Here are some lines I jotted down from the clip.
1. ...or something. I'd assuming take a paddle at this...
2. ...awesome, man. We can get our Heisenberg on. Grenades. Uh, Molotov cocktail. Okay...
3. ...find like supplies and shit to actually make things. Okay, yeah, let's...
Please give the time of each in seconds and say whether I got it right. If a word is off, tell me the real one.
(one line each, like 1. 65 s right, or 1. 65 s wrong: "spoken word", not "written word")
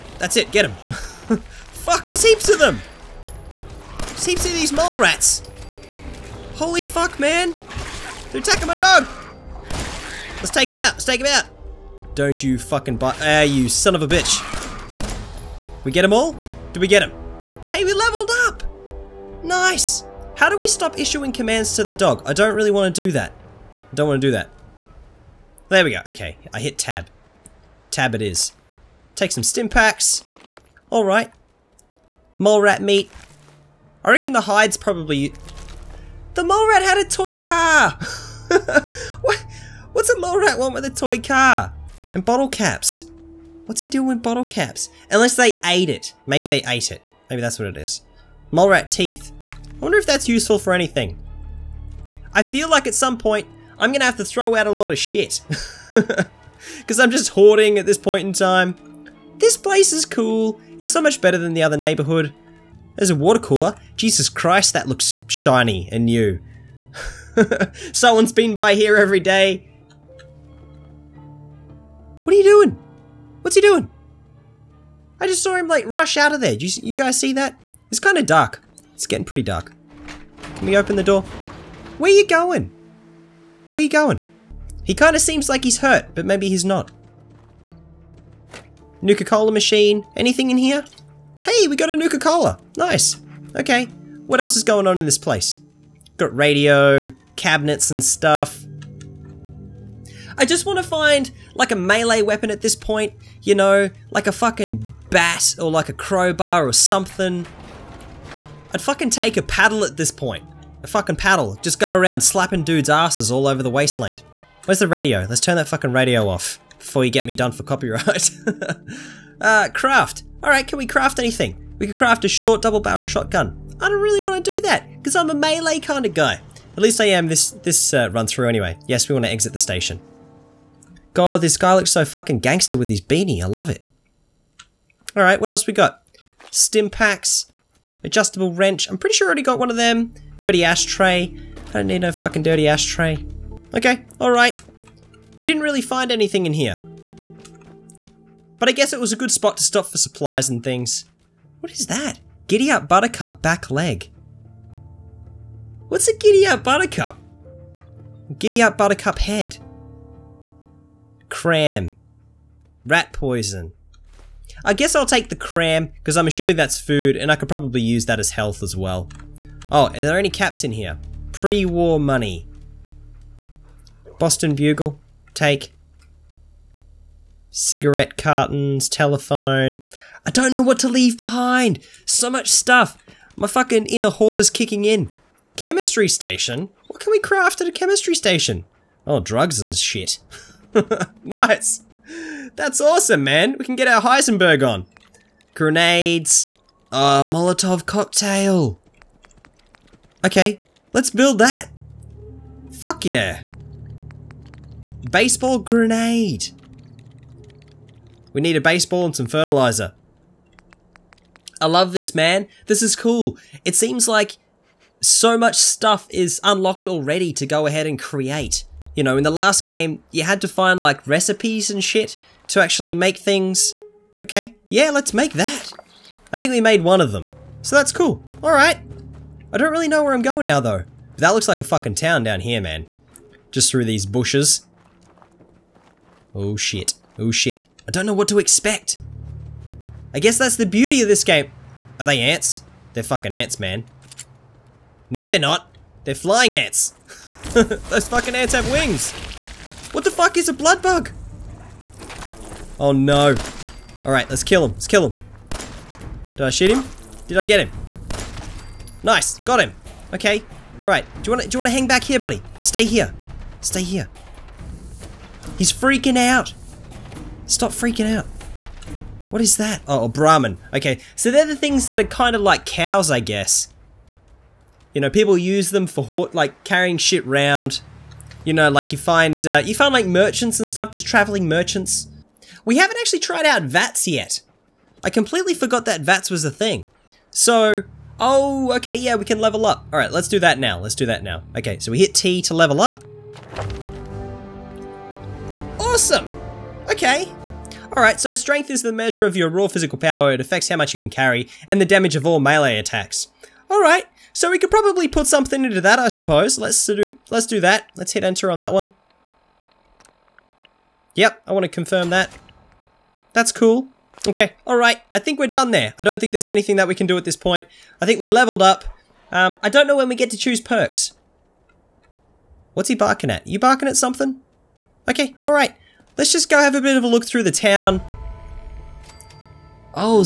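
1. 106 s wrong: "fucking", not "assuming"
2. 192 s right
3. 220 s wrong: "recipes", not "supplies".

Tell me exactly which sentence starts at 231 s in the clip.
But that looks like a fucking town down here, man.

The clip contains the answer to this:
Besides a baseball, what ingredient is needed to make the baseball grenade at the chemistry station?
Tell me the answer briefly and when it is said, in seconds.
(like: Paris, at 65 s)
Fertilizer, at 209 s.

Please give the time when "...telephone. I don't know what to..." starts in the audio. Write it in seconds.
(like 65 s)
178 s.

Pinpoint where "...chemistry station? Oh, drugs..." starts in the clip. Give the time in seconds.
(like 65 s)
187 s.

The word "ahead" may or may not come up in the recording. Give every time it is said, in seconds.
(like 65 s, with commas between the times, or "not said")
217 s.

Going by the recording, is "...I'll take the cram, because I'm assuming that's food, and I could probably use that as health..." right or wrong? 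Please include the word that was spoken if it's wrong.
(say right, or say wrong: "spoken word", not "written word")
right.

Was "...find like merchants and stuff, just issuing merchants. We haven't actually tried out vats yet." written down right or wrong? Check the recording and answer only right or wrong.
wrong.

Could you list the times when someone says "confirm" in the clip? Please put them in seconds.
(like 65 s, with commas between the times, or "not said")
311 s.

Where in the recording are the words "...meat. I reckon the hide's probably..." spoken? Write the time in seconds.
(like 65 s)
32 s.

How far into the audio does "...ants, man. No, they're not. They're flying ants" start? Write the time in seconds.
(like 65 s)
243 s.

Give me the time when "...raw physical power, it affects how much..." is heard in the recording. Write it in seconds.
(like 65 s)
299 s.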